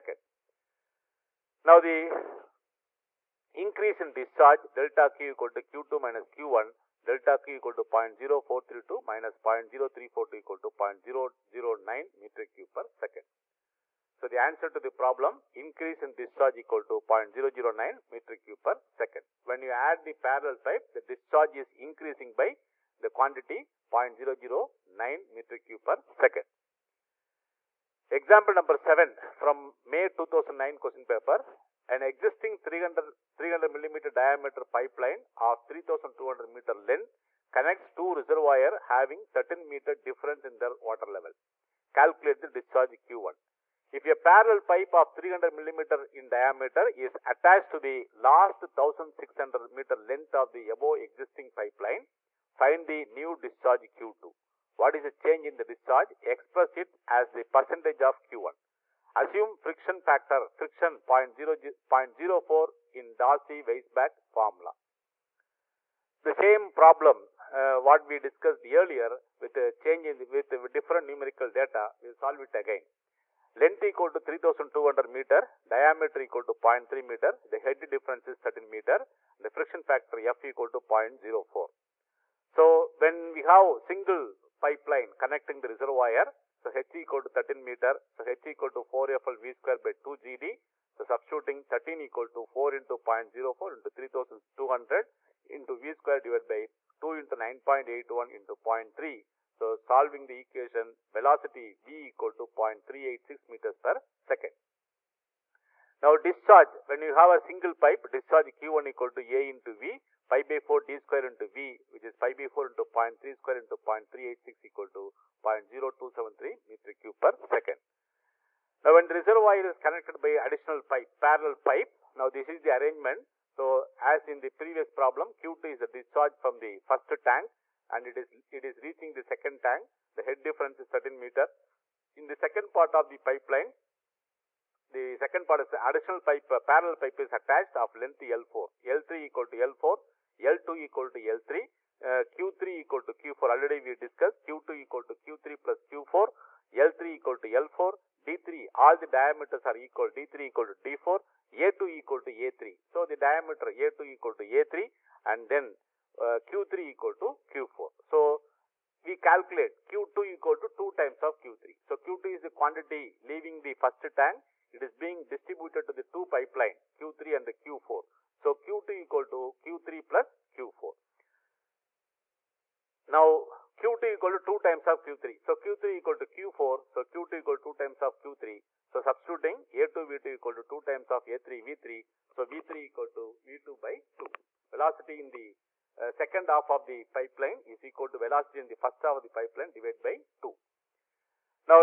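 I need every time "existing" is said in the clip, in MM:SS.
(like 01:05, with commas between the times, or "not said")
00:32, 00:51.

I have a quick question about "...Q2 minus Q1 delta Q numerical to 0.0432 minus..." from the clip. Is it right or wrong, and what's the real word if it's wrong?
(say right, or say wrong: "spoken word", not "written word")
wrong: "equal", not "numerical".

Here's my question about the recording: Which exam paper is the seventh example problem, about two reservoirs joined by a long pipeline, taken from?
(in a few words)
May 2009.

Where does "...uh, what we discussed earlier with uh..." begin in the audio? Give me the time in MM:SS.
01:07.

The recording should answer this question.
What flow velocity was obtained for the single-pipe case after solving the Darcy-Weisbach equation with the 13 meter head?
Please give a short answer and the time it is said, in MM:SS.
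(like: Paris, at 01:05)
0.386 m/s, at 01:42.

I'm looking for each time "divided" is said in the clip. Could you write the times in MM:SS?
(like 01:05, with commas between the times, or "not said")
01:36, 03:09.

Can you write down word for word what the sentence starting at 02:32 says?
So, the diameter A2 equal to A3 and then uh, Q3 equal to Q4.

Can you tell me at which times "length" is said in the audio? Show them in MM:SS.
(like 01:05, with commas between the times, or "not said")
00:36, 00:50, 01:13, 02:17.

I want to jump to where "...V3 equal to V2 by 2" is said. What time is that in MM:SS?
03:02.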